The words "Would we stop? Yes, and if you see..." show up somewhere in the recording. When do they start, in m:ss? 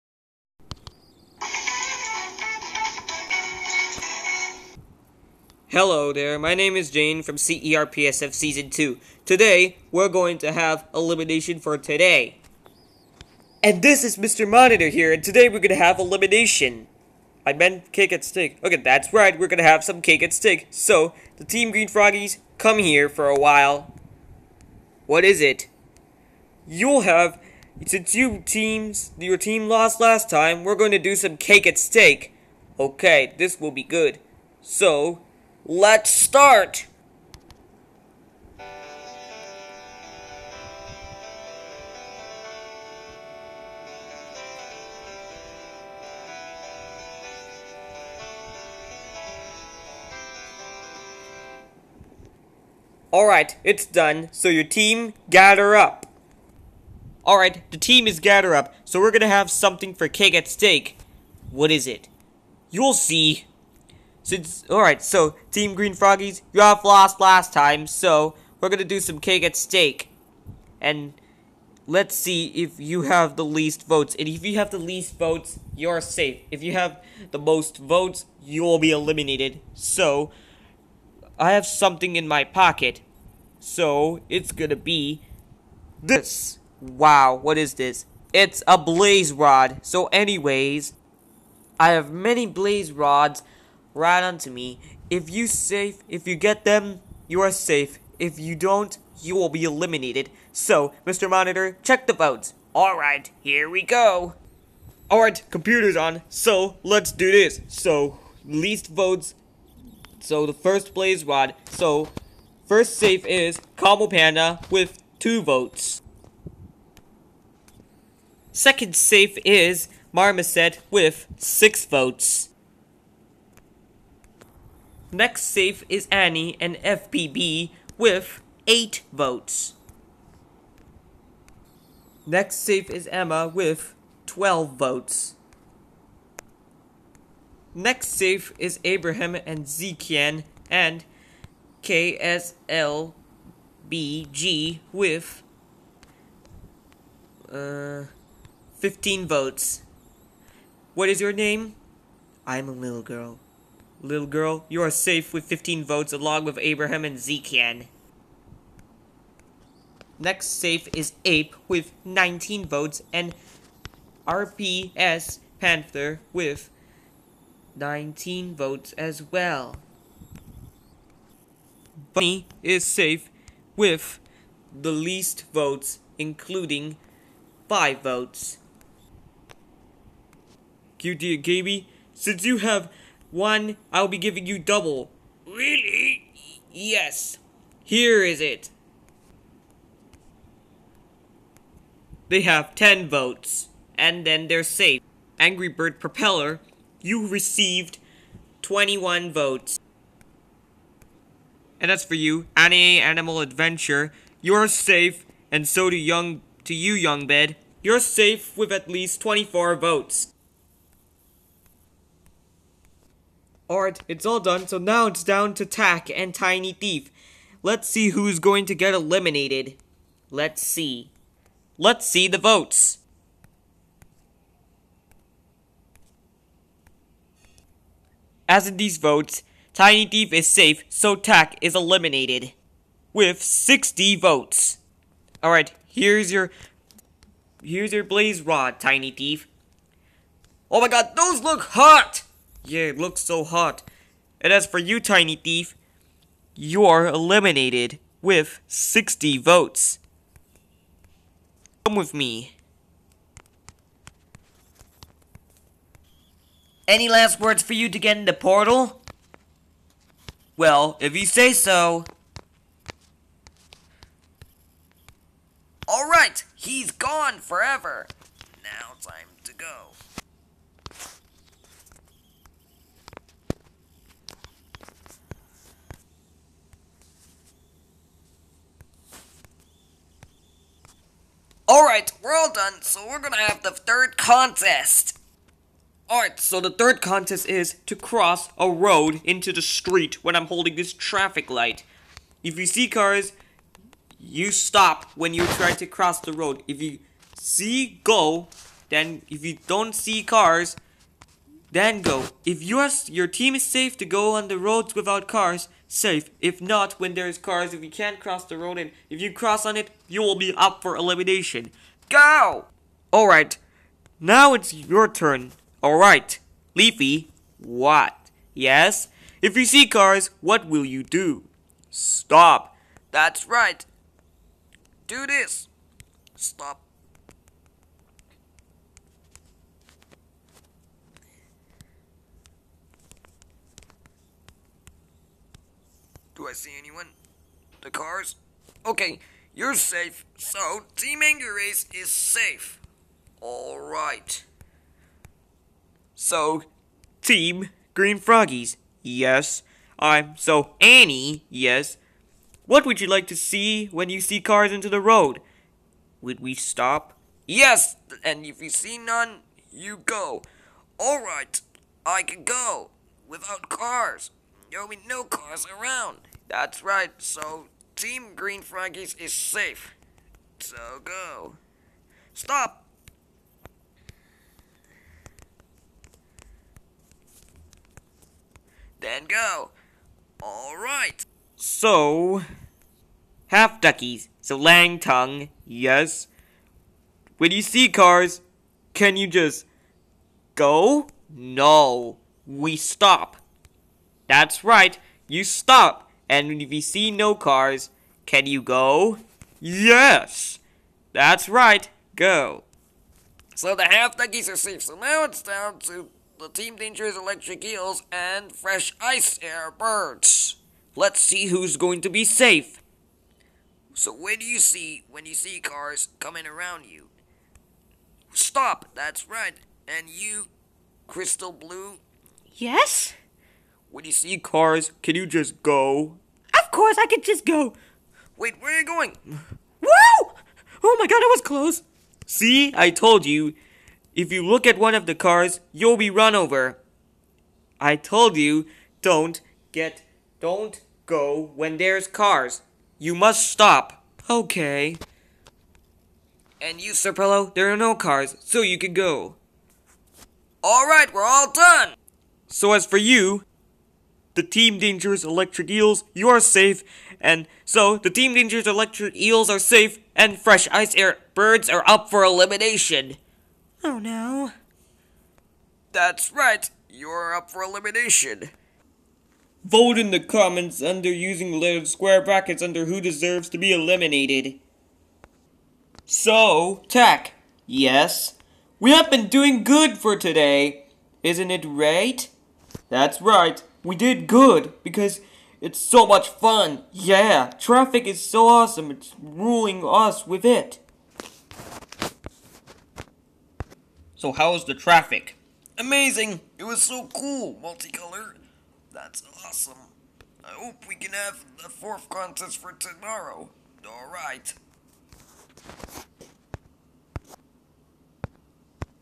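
5:56.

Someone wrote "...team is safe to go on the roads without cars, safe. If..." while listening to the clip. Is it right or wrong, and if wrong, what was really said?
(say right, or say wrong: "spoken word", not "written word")
right.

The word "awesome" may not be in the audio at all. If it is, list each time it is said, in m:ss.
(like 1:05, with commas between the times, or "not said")
8:08, 8:19.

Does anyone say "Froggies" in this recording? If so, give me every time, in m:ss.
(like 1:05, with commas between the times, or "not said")
0:21, 1:05, 5:48, 6:08.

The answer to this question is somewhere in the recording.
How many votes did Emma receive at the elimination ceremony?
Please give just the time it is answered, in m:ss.
2:14.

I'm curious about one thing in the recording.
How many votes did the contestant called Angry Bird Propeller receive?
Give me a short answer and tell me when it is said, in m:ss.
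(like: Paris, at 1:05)
21, at 3:18.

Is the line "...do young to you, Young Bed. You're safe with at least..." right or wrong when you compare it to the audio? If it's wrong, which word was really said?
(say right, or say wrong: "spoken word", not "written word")
right.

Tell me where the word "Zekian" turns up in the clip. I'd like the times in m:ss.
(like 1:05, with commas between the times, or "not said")
2:19, 2:37.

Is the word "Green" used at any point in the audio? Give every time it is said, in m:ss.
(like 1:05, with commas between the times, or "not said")
0:21, 1:05, 5:47, 6:08.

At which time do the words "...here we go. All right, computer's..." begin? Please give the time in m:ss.
1:43.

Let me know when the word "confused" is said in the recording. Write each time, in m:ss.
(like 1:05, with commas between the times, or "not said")
not said.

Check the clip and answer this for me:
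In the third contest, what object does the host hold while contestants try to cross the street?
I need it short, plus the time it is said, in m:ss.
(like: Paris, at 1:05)
Traffic light, at 4:50.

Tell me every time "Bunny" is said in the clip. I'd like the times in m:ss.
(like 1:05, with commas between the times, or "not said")
2:52.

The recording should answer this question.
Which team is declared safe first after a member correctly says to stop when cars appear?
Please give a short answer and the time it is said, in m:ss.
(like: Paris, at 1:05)
Team Angry Race, at 5:40.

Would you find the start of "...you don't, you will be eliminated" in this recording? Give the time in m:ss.
1:38.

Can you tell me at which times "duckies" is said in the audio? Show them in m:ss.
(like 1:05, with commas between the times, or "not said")
6:23, 6:44.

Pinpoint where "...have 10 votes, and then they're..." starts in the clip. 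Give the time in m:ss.
3:12.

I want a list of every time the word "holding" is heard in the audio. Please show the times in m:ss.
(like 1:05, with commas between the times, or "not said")
4:50.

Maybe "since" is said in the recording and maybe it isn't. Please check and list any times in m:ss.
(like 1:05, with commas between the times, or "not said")
0:27, 1:04, 3:02.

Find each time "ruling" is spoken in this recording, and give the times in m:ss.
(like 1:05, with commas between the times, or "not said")
8:09.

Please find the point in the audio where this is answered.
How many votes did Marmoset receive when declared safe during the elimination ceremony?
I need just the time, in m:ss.
2:01.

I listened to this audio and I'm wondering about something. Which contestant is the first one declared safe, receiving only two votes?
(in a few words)
Combo Panda.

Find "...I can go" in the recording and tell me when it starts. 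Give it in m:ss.
6:02.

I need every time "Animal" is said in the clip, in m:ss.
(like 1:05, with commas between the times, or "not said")
3:22.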